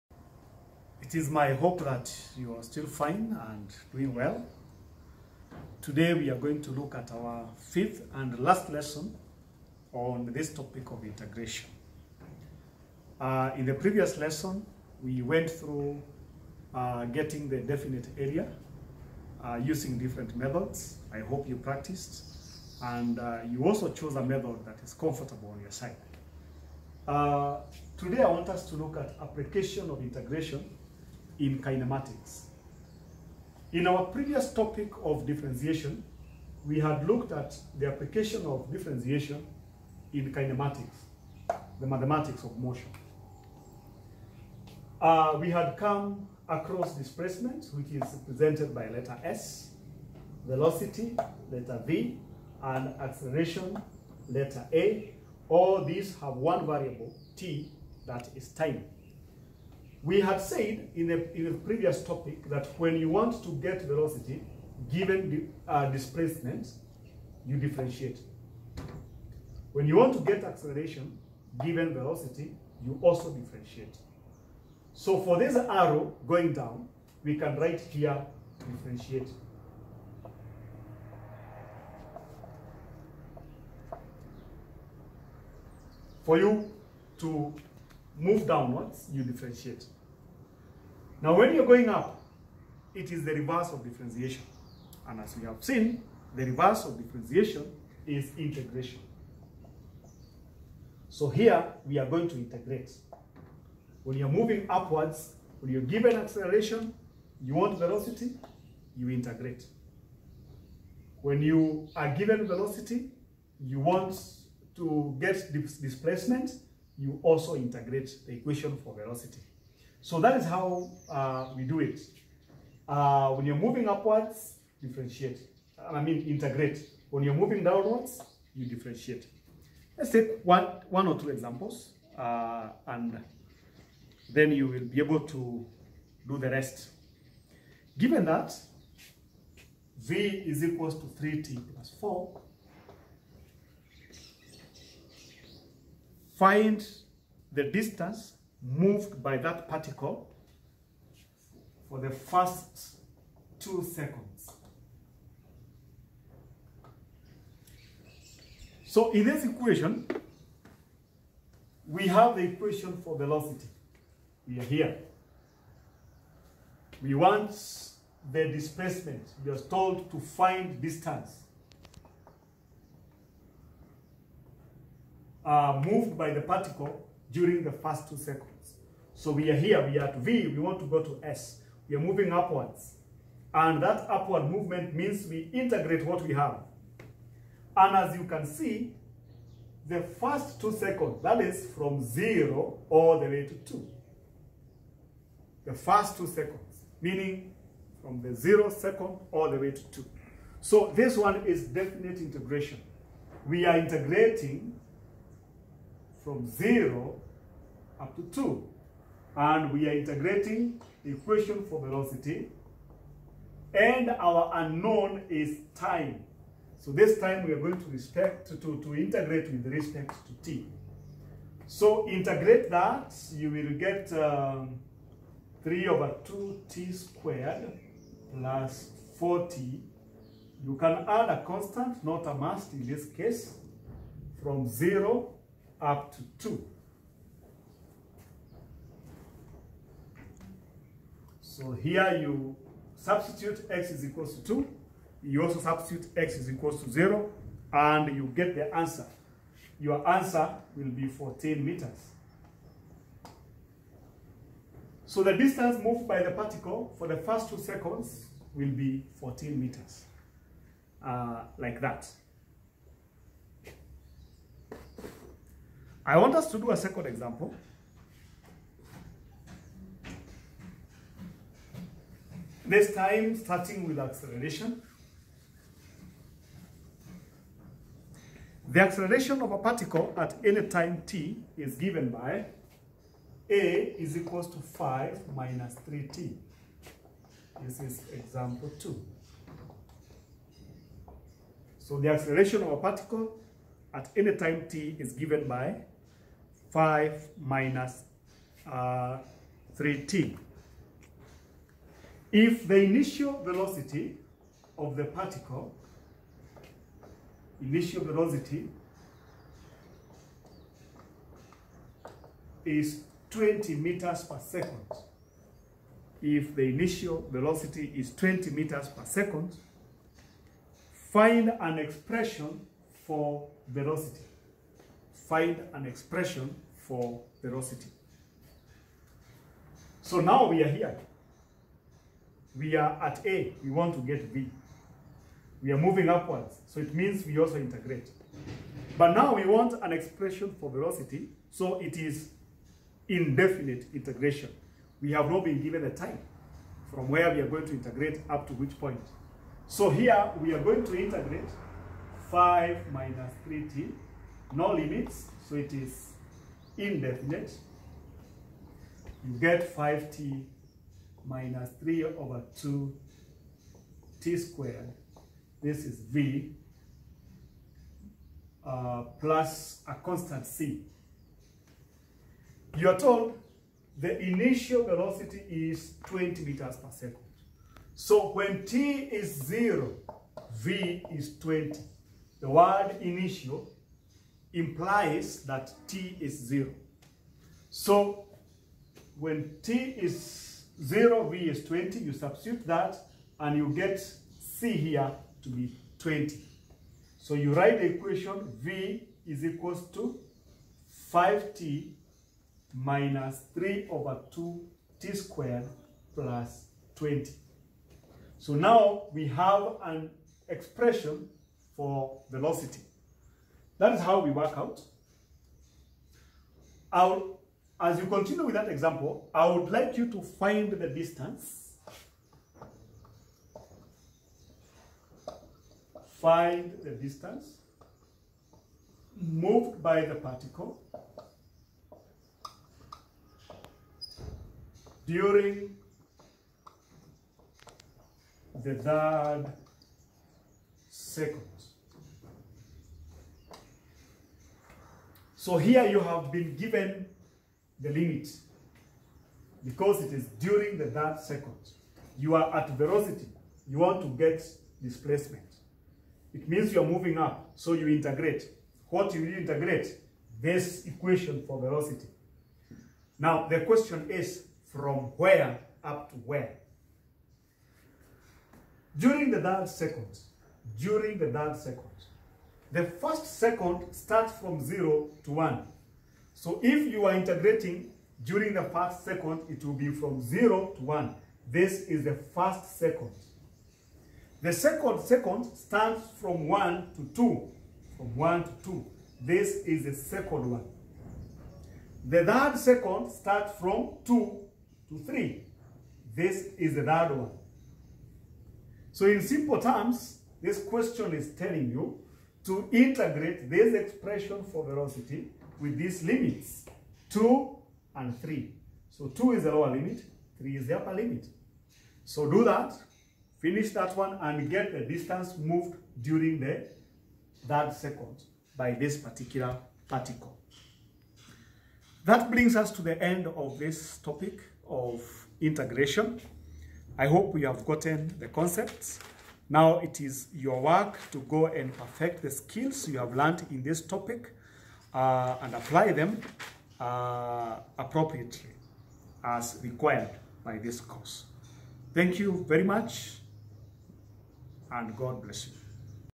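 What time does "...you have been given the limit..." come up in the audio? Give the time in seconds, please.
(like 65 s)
445 s.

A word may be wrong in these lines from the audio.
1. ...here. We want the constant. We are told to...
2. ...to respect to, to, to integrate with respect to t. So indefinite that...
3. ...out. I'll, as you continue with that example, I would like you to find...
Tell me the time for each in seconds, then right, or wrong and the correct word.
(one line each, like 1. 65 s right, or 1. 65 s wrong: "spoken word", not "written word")
1. 164 s wrong: "displacement", not "constant"
2. 217 s wrong: "integrate", not "indefinite"
3. 414 s right.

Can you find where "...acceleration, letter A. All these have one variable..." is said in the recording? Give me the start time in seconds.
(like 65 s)
53 s.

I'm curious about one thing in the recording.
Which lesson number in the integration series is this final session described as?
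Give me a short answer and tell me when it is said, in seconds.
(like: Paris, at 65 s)
fifth, at 7 s.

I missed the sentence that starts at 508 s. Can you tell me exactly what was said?
So 2 is the lower limit, 3 is the upper limit.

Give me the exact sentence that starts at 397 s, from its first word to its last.
So you write the equation v is equals to 5t minus 3 over 2t squared plus 20.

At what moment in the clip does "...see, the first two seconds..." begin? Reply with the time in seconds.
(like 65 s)
188 s.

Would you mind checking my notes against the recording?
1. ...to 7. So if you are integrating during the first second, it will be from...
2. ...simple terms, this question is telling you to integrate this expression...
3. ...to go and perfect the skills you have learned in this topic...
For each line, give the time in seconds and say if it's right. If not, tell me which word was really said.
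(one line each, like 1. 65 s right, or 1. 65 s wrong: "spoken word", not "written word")
1. 475 s wrong: "1", not "7"
2. 499 s right
3. 531 s right.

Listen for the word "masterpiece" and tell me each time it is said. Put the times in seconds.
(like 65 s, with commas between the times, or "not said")
not said.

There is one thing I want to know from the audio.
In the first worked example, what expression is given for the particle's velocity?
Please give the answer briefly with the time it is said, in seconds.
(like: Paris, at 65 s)
3t + 4, at 141 s.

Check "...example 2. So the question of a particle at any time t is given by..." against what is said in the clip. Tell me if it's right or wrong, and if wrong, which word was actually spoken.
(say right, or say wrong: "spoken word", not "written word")
wrong: "acceleration", not "question".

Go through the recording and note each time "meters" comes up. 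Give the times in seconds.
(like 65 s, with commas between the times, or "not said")
251 s, 259 s, 313 s, 318 s, 376 s.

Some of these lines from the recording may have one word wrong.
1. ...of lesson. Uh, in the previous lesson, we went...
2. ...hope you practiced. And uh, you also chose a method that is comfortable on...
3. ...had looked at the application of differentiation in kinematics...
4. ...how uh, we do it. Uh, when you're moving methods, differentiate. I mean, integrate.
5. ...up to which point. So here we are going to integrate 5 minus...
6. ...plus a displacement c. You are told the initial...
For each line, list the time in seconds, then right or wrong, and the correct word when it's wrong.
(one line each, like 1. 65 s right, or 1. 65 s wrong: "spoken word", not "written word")
1. 10 s wrong: "integration", not "lesson"
2. 21 s right
3. 36 s right
4. 120 s wrong: "upwards", not "methods"
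5. 348 s right
6. 369 s wrong: "constant", not "displacement".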